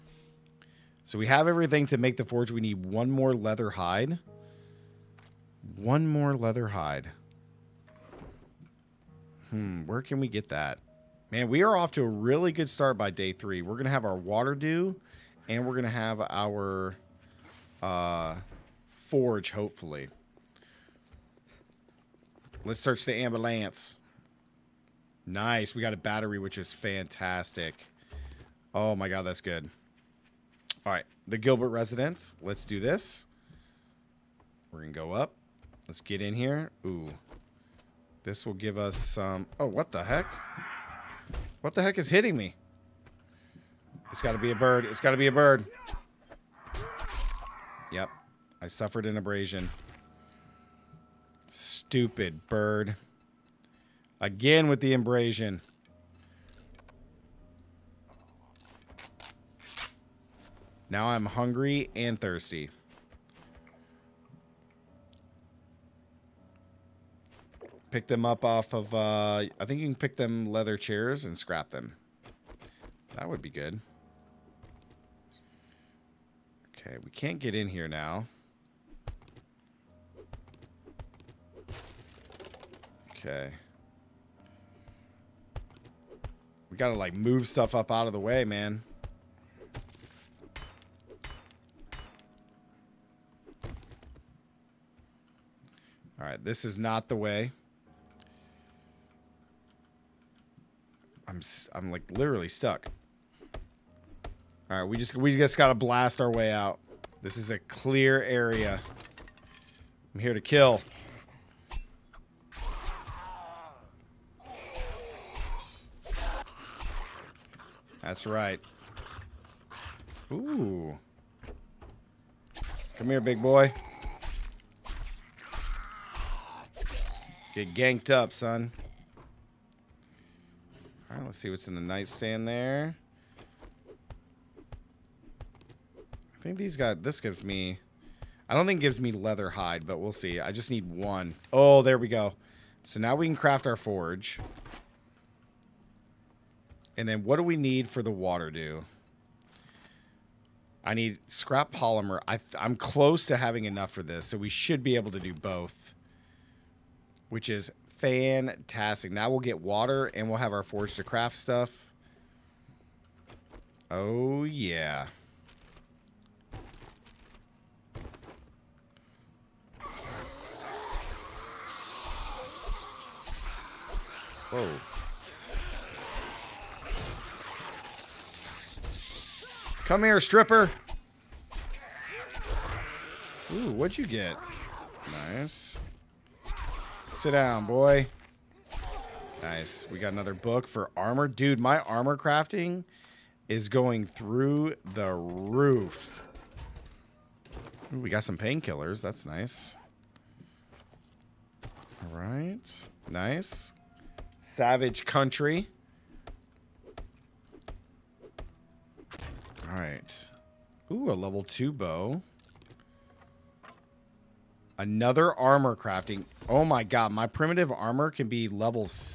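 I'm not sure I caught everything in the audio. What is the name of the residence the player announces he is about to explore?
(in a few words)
Gilbert residence.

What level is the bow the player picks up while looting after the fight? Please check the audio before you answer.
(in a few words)
2.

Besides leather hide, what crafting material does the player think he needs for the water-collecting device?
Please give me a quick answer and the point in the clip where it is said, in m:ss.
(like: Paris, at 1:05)
Scrap polymer, at 2:31.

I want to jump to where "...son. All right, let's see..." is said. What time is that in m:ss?
2:08.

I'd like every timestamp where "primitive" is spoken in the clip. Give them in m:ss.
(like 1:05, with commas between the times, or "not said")
3:37.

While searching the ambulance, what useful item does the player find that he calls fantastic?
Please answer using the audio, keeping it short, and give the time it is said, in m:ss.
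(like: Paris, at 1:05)
Battery, at 0:25.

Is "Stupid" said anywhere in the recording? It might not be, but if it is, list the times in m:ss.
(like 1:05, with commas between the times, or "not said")
0:51.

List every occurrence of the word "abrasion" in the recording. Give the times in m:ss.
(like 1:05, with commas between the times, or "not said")
0:49, 0:54.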